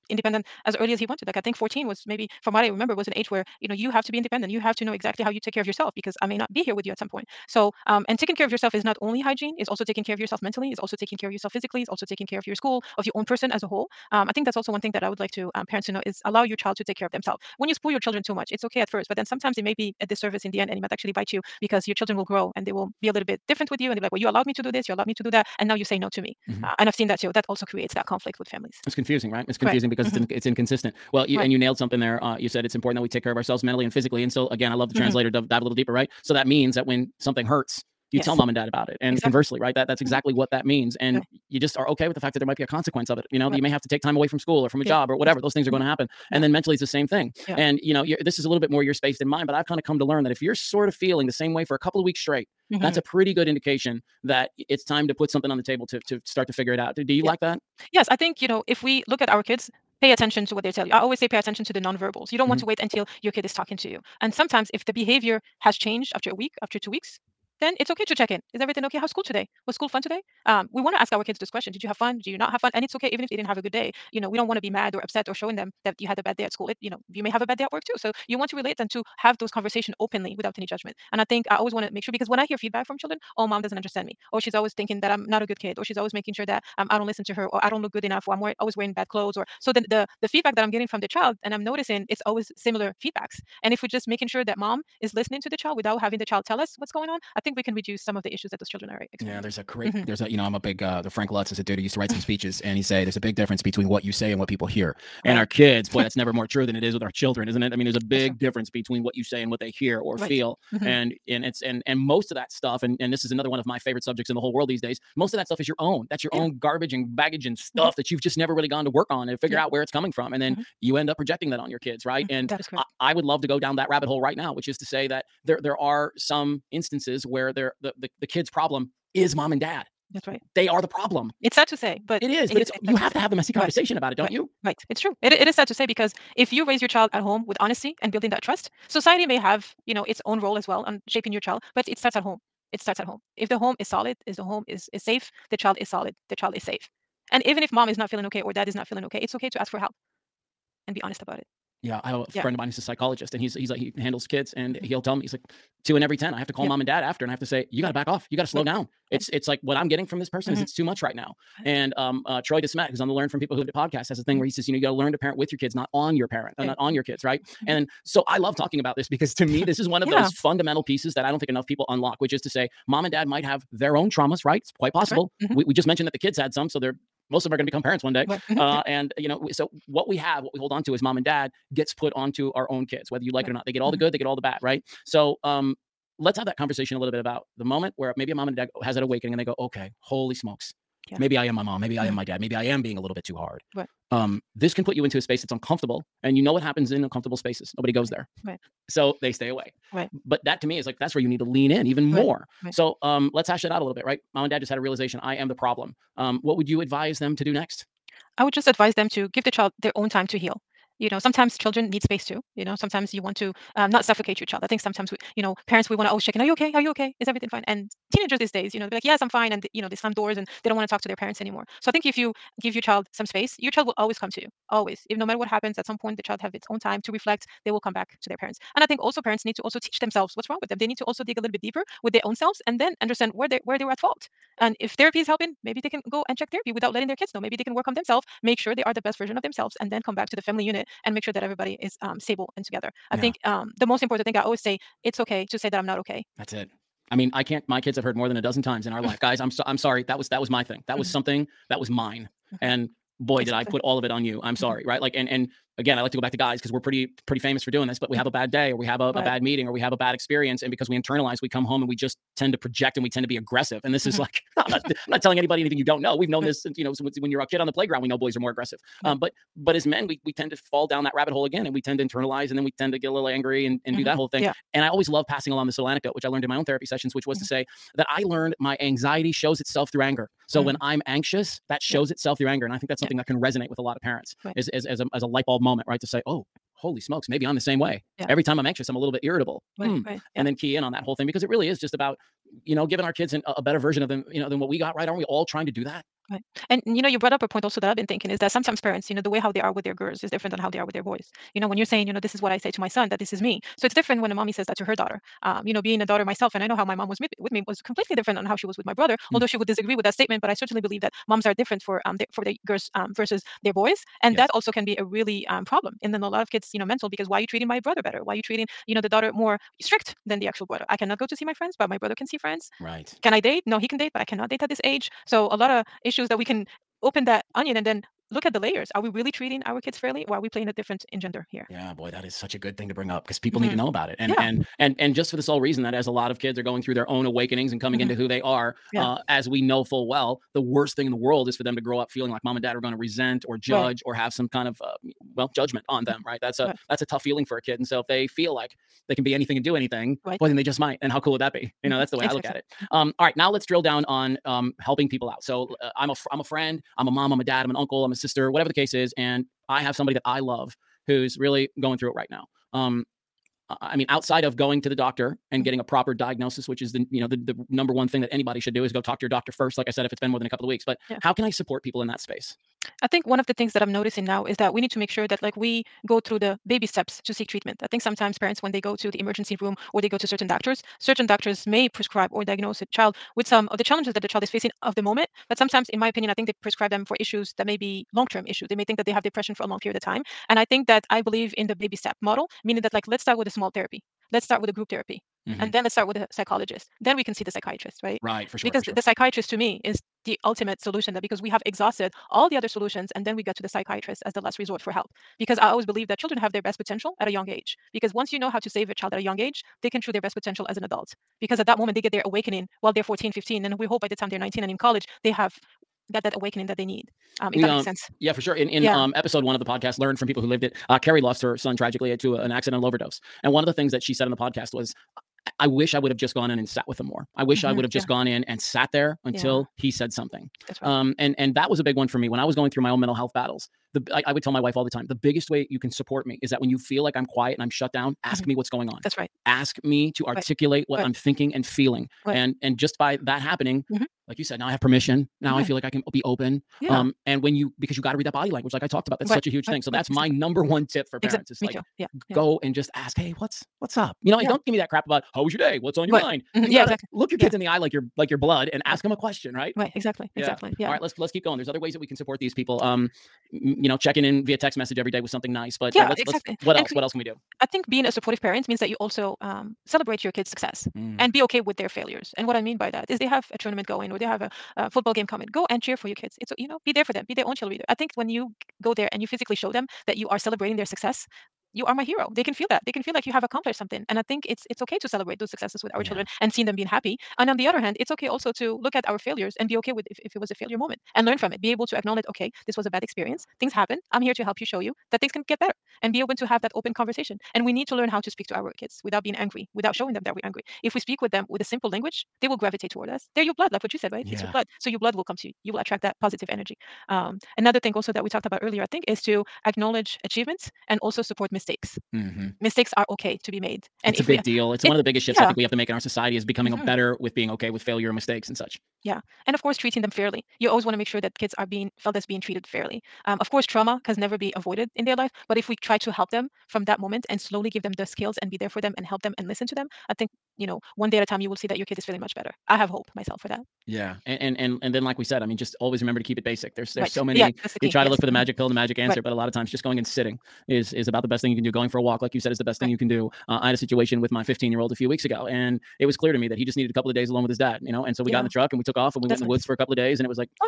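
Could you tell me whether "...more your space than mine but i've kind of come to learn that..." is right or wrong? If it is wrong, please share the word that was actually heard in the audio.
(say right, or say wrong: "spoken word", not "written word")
right.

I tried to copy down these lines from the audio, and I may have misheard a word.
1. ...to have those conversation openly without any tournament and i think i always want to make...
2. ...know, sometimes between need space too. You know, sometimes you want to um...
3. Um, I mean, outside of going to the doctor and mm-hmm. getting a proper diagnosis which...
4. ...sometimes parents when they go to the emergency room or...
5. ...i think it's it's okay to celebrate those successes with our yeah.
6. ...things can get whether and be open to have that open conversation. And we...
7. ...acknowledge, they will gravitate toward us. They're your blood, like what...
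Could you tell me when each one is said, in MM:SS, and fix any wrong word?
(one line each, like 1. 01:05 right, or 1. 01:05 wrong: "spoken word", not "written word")
1. 01:18 wrong: "judgment", not "tournament"
2. 03:31 wrong: "children", not "between"
3. 06:02 right
4. 06:18 right
5. 08:04 right
6. 08:15 wrong: "better", not "whether"
7. 08:21 wrong: "language", not "acknowledge".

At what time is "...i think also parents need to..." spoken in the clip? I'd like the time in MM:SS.
03:48.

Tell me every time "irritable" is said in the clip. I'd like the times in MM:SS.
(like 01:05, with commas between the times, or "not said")
04:49.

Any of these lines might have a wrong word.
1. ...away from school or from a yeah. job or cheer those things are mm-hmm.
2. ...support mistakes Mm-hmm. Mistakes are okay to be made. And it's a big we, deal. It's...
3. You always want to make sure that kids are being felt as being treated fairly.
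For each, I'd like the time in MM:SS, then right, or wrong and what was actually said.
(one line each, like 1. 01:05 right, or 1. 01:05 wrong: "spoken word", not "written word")
1. 00:44 wrong: "whatever", not "cheer"
2. 08:31 right
3. 08:40 right.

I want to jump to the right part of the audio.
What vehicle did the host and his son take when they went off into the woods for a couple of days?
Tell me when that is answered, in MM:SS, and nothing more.
09:08.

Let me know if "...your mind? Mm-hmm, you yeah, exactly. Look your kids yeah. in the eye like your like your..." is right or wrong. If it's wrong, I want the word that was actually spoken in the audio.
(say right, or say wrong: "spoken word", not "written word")
right.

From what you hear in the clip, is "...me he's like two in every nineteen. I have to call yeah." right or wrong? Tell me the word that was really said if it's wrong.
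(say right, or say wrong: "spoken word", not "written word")
wrong: "ten", not "nineteen".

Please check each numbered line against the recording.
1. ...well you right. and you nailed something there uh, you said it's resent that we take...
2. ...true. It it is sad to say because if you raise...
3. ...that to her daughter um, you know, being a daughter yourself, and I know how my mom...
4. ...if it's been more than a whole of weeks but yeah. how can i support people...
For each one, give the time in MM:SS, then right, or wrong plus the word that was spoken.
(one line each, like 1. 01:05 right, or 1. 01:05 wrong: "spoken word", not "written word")
1. 00:31 wrong: "important", not "resent"
2. 02:14 right
3. 05:04 wrong: "myself", not "yourself"
4. 06:10 wrong: "couple", not "whole".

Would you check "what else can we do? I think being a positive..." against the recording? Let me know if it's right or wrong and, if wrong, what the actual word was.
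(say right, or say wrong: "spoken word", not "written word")
wrong: "supportive", not "positive".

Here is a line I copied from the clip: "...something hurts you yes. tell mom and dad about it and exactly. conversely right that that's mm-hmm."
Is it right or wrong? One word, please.
right.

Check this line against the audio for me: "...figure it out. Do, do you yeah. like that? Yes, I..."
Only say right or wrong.
right.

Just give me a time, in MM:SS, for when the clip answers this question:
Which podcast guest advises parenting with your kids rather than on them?
02:42.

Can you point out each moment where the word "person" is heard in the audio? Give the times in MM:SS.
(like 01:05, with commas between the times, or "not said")
00:13, 02:40.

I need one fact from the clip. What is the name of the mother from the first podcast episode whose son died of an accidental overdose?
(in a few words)
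Carrie.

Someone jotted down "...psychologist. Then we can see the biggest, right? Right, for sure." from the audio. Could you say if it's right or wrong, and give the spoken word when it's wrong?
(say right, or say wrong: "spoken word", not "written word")
wrong: "psychiatrist", not "biggest".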